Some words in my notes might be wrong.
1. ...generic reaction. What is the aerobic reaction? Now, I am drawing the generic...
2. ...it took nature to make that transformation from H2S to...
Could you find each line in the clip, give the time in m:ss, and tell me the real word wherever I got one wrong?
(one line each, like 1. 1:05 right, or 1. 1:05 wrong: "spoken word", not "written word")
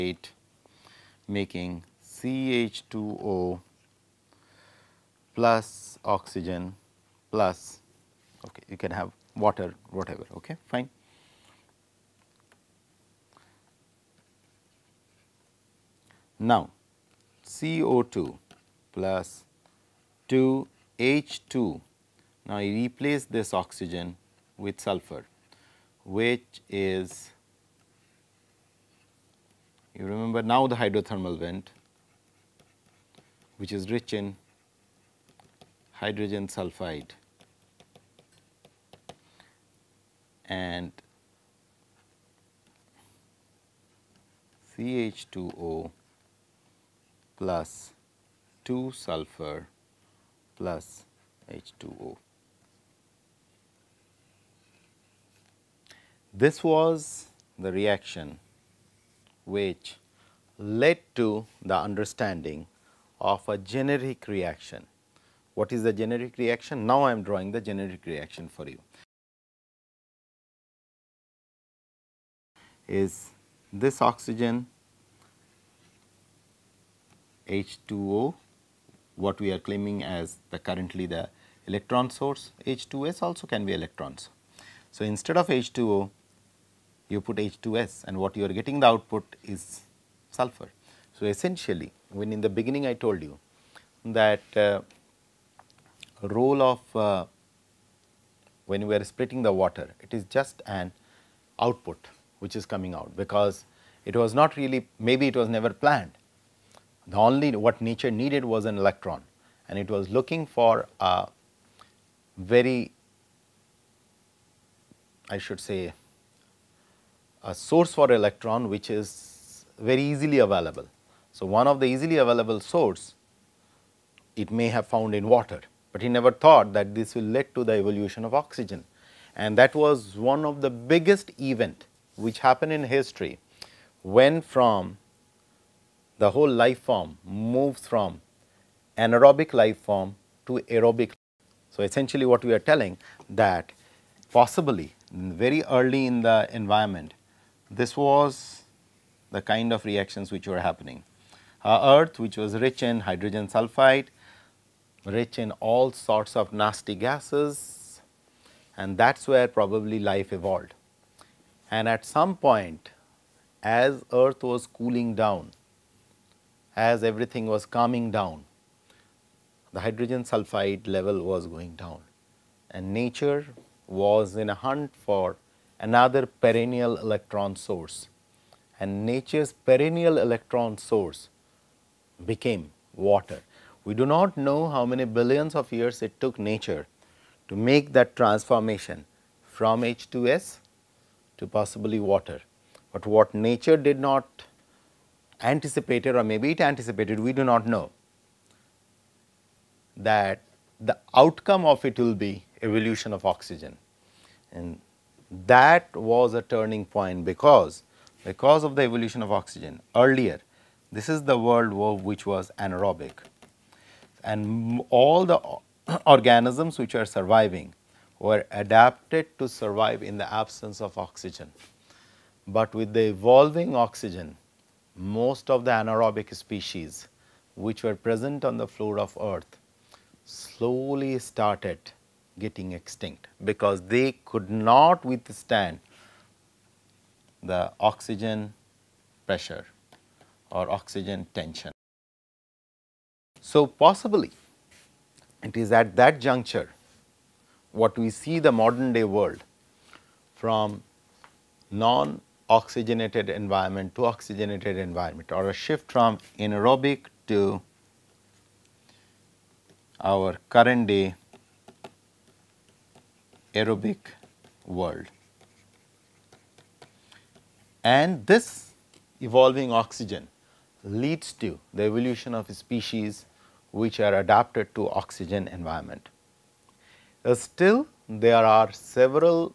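1. 1:03 wrong: "generic", not "aerobic"
2. 3:06 right.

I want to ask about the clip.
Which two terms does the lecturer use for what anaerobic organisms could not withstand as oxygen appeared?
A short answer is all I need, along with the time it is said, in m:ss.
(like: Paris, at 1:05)
Oxygen pressure or oxygen tension, at 3:57.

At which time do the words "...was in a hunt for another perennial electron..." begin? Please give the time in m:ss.
2:53.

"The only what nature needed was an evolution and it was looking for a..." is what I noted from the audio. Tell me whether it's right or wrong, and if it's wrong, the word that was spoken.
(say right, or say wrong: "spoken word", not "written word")
wrong: "electron", not "evolution".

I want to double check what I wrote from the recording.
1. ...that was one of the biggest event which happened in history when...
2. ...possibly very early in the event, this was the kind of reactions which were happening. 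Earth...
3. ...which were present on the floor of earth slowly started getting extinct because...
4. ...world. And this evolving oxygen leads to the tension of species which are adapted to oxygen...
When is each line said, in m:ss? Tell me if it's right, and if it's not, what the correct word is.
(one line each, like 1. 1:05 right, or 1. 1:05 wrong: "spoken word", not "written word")
1. 2:09 right
2. 2:24 wrong: "environment", not "event"
3. 3:47 right
4. 4:24 wrong: "evolution", not "tension".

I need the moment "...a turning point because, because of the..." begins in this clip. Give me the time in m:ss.
3:26.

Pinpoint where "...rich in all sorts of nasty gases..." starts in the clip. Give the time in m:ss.
2:35.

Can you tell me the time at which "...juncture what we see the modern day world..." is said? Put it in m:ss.
4:06.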